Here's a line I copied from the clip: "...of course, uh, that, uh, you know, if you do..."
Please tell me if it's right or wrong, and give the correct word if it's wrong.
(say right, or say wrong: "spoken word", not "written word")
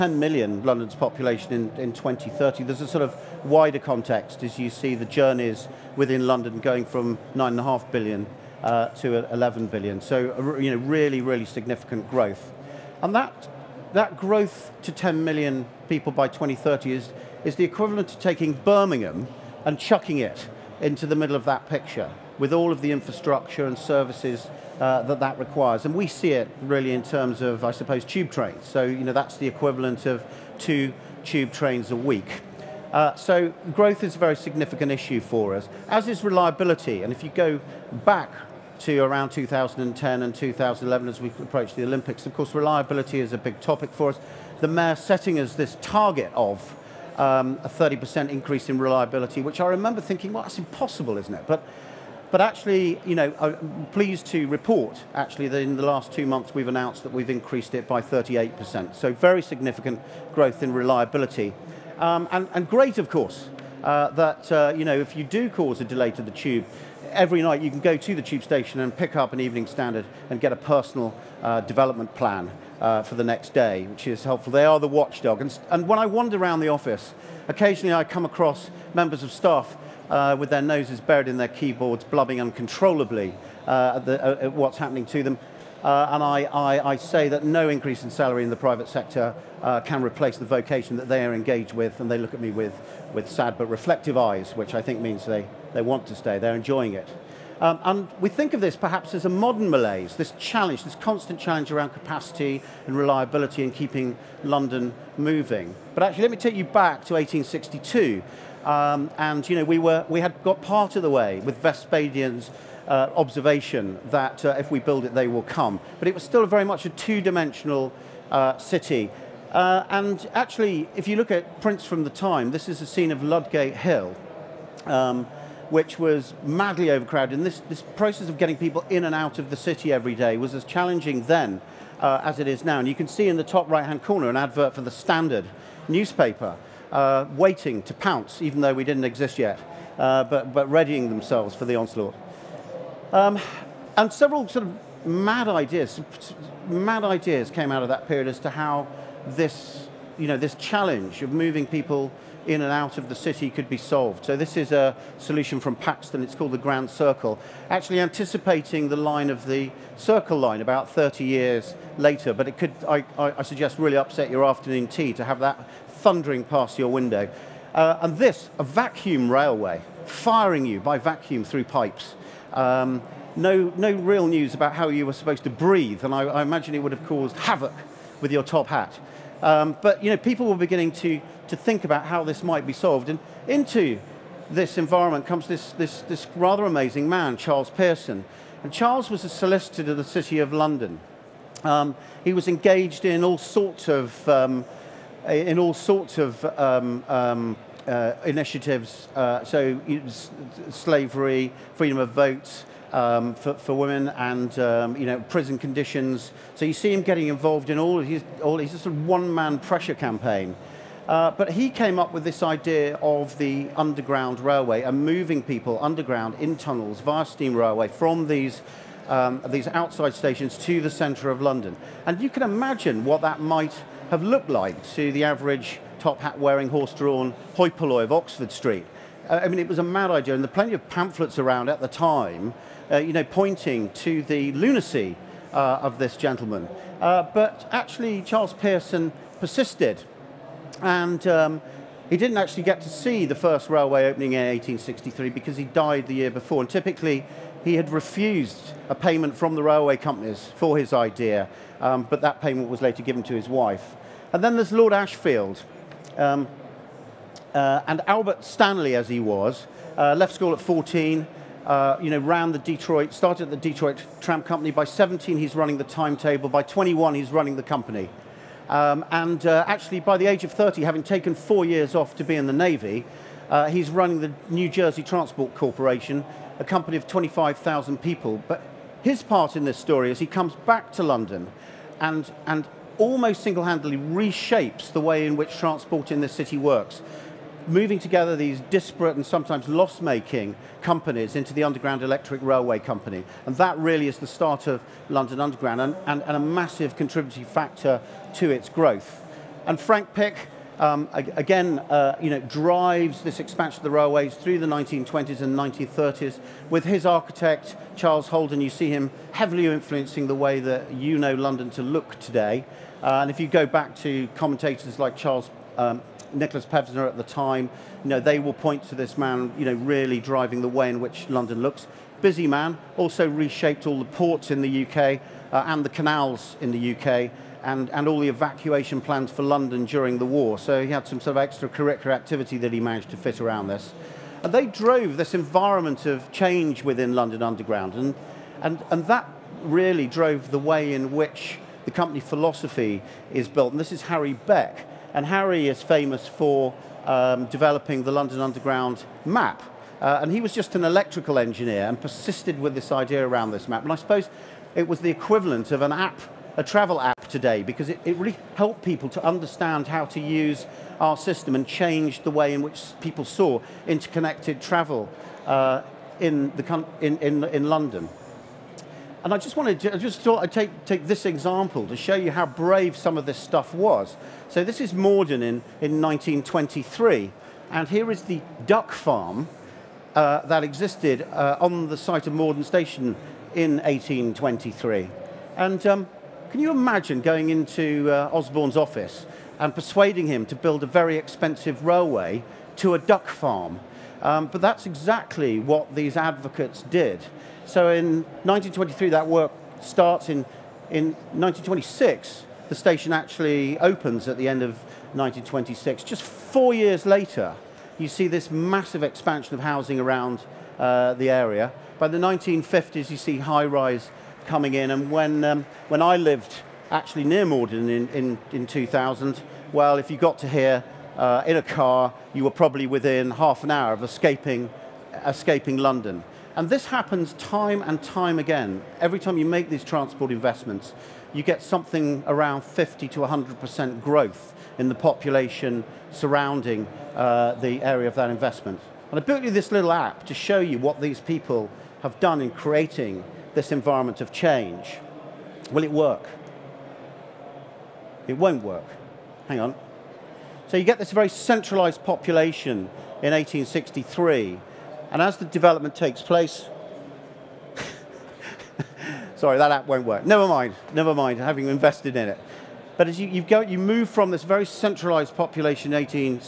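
right.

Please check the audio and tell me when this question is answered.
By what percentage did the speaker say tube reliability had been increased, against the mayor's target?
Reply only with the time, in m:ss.
0:58.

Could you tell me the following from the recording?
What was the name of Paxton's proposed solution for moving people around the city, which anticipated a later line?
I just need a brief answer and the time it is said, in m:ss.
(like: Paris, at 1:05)
Grand Circle, at 2:36.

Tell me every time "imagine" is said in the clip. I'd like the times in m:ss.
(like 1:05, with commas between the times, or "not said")
2:56, 3:42, 6:26.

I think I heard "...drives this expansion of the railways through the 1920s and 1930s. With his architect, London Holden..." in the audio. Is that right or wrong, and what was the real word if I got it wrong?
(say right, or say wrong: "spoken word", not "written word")
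wrong: "Charles", not "London".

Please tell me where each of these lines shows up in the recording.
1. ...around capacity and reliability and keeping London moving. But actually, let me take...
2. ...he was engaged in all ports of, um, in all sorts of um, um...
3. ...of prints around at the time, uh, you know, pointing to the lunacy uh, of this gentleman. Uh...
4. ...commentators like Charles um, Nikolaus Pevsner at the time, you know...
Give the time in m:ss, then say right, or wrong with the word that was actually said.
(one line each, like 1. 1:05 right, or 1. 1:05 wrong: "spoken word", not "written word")
1. 1:41 right
2. 3:12 wrong: "sorts", not "ports"
3. 3:50 wrong: "pamphlets", not "prints"
4. 5:14 right.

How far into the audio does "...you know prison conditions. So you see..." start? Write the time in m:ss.
3:24.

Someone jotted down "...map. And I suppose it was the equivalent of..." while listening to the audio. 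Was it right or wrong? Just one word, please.
right.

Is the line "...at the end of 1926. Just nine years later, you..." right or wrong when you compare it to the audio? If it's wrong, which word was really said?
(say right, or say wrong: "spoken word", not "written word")
wrong: "four", not "nine".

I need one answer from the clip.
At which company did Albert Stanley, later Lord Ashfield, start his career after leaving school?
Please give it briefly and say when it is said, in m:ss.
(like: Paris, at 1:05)
Detroit Tram Company, at 4:23.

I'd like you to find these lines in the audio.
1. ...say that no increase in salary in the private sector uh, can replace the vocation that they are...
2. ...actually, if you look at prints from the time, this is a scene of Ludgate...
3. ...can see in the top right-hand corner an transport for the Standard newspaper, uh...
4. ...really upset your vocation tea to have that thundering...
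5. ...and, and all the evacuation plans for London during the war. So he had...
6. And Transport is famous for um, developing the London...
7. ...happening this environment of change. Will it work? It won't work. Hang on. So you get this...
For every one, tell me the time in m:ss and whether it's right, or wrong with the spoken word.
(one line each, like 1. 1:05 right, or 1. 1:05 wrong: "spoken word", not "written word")
1. 1:26 right
2. 2:00 right
3. 2:12 wrong: "advert", not "transport"
4. 2:43 wrong: "afternoon", not "vocation"
5. 5:27 right
6. 5:45 wrong: "Harry", not "Transport"
7. 7:22 wrong: "creating", not "happening".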